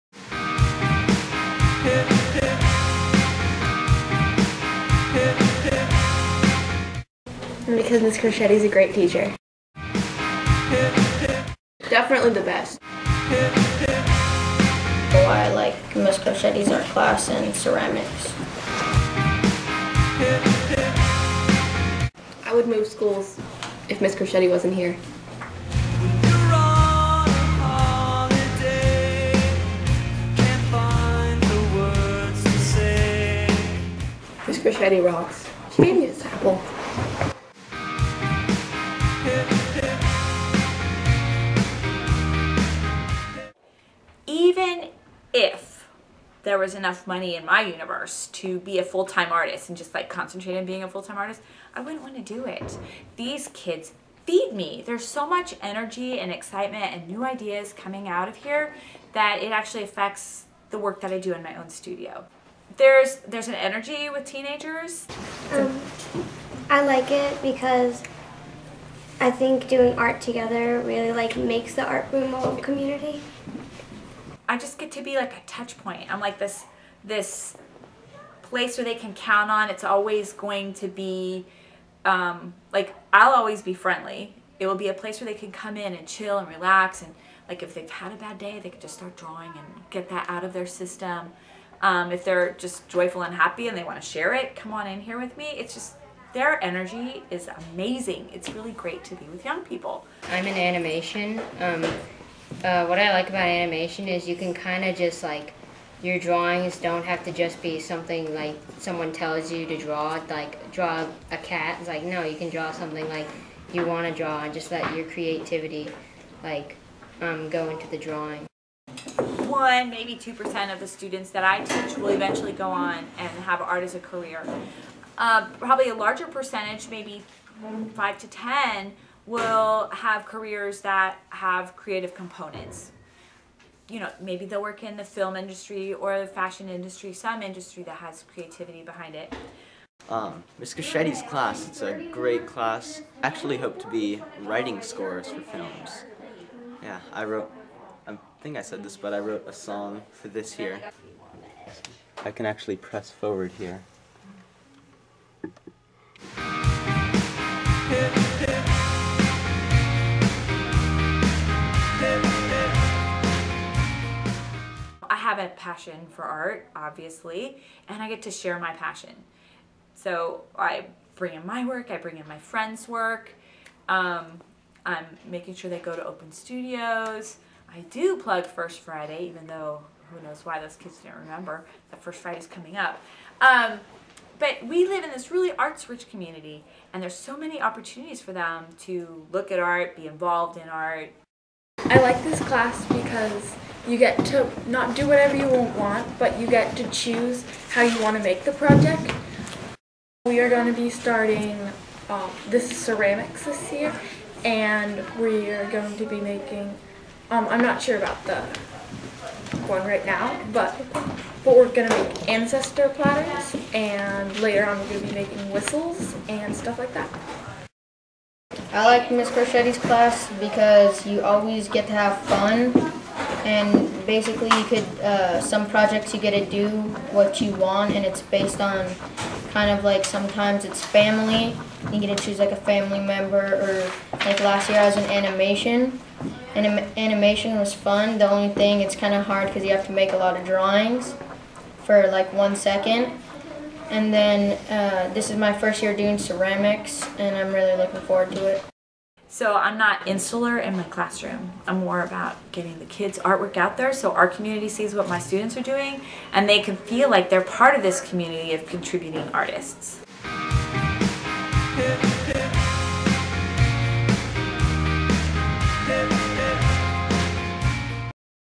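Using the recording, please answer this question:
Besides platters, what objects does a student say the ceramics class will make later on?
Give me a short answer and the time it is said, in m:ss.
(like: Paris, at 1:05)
whistles, at 3:35.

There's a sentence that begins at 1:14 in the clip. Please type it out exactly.
I just get to be like a touch point.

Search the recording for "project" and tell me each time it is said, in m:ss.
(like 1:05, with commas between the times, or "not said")
3:18, 3:45.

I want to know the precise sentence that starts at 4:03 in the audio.
And then uh, this is my first year doing ceramics and I'm really looking forward to it.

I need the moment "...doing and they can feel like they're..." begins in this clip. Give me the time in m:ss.
4:15.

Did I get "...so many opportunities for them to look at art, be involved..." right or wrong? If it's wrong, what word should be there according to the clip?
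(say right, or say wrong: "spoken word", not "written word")
right.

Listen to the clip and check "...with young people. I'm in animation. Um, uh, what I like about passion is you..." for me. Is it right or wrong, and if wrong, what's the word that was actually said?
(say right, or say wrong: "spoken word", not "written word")
wrong: "animation", not "passion".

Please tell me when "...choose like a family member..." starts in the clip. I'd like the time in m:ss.
3:52.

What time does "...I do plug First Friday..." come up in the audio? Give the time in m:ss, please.
2:57.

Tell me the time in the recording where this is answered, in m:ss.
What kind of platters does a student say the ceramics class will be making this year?
3:32.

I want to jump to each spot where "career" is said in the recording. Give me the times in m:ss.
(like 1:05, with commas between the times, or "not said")
2:03, 2:10.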